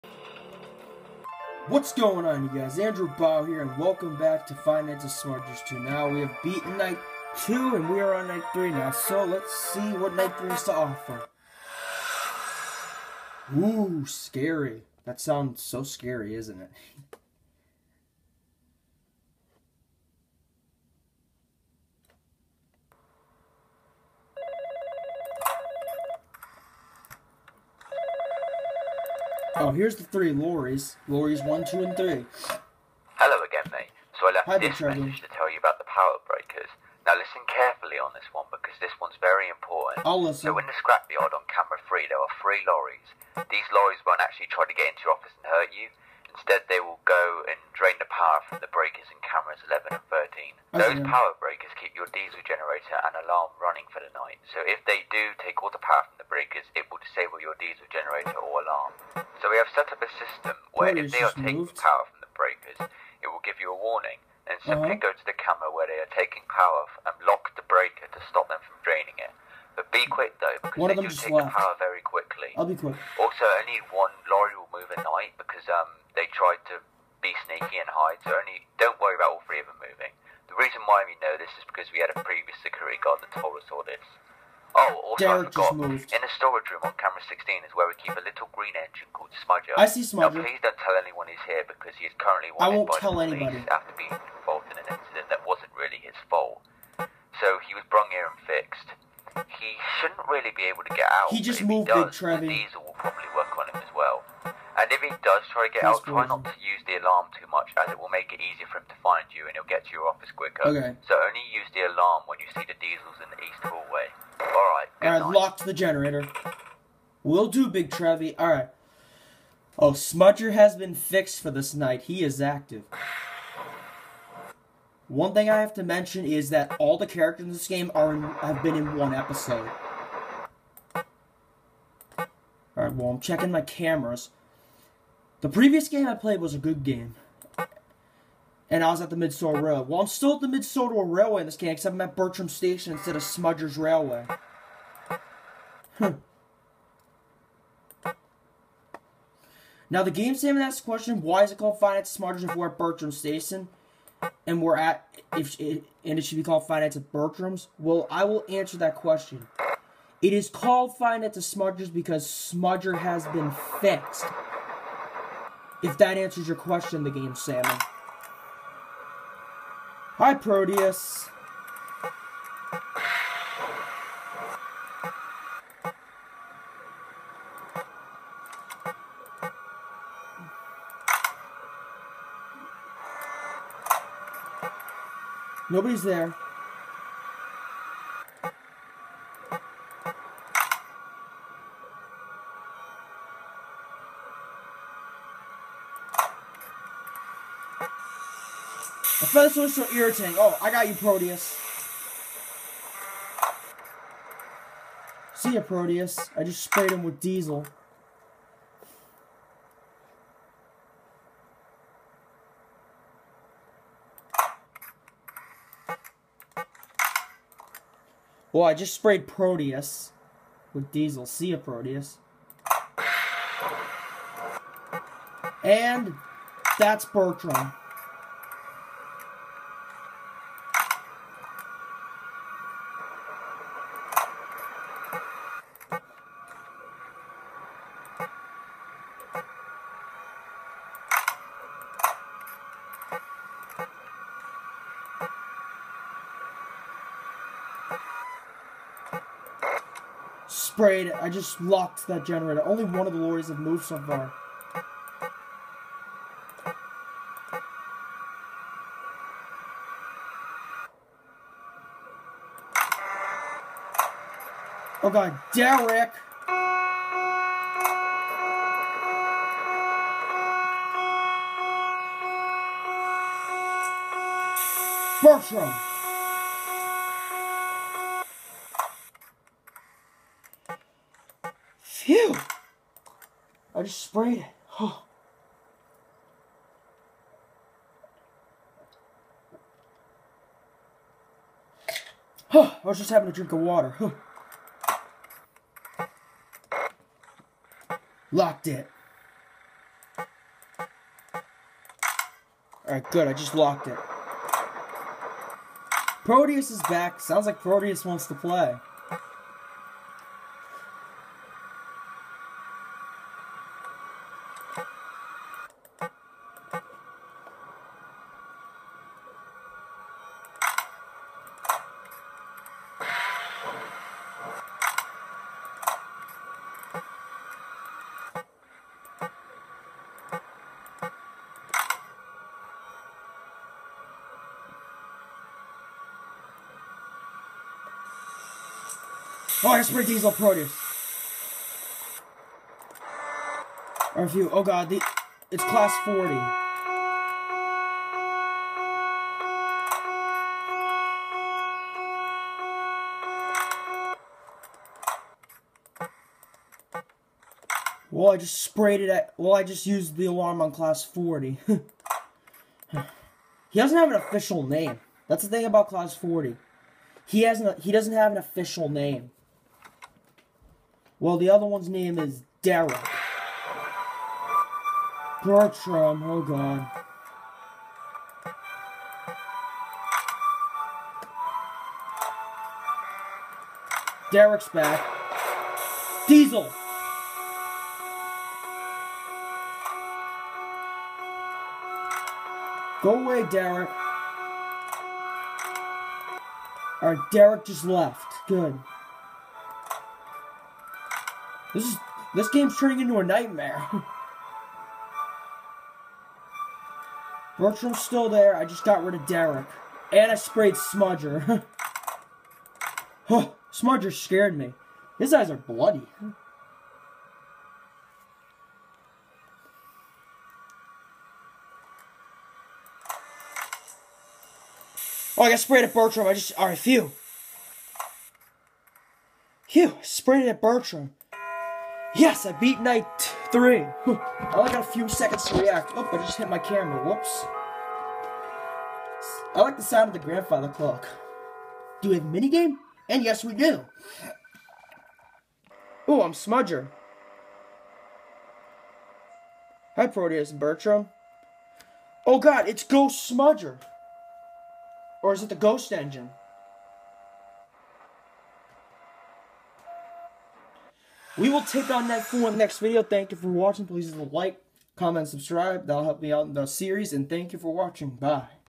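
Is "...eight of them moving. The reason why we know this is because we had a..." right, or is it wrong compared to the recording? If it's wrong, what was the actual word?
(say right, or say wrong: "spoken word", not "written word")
wrong: "three", not "eight".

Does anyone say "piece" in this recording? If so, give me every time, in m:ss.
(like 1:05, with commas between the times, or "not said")
not said.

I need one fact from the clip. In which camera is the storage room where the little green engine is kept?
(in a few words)
Camera 16.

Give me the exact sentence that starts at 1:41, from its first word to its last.
He just moved he does, it, Trevi.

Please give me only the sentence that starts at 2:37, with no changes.
Well, I will answer that question.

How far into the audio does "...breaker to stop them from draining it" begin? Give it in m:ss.
1:07.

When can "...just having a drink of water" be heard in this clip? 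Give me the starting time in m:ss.
4:52.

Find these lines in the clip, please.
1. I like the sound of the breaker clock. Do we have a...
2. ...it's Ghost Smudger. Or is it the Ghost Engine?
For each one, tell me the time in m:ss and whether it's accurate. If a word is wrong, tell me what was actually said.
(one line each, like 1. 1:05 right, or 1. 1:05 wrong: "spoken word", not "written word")
1. 7:19 wrong: "grandfather", not "breaker"
2. 7:32 right.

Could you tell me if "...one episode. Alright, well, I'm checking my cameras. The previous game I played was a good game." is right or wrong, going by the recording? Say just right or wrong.
right.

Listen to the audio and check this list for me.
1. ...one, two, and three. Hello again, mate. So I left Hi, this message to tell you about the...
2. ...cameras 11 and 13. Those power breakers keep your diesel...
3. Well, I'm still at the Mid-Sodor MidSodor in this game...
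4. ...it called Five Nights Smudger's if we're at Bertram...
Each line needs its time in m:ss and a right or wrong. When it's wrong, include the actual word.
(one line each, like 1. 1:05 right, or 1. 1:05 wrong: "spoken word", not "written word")
1. 0:31 right
2. 0:49 right
3. 2:19 wrong: "Railway", not "MidSodor"
4. 2:31 right.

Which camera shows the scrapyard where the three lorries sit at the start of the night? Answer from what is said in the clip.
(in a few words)
Camera 3.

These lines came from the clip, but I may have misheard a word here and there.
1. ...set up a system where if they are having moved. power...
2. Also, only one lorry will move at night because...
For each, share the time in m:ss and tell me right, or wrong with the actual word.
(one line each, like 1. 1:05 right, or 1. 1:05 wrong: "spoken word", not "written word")
1. 0:59 wrong: "taking", not "having"
2. 1:13 right.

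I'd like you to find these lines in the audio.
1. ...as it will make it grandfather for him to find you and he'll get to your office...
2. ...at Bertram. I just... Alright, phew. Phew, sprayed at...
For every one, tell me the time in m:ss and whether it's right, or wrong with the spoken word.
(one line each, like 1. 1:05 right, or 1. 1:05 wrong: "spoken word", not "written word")
1. 1:47 wrong: "easier", not "grandfather"
2. 7:05 right.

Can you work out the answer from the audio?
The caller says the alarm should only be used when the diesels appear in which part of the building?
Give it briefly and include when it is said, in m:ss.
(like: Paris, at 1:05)
East hallway, at 1:53.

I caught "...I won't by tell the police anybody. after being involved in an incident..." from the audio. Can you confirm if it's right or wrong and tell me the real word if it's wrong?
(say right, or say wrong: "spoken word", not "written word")
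right.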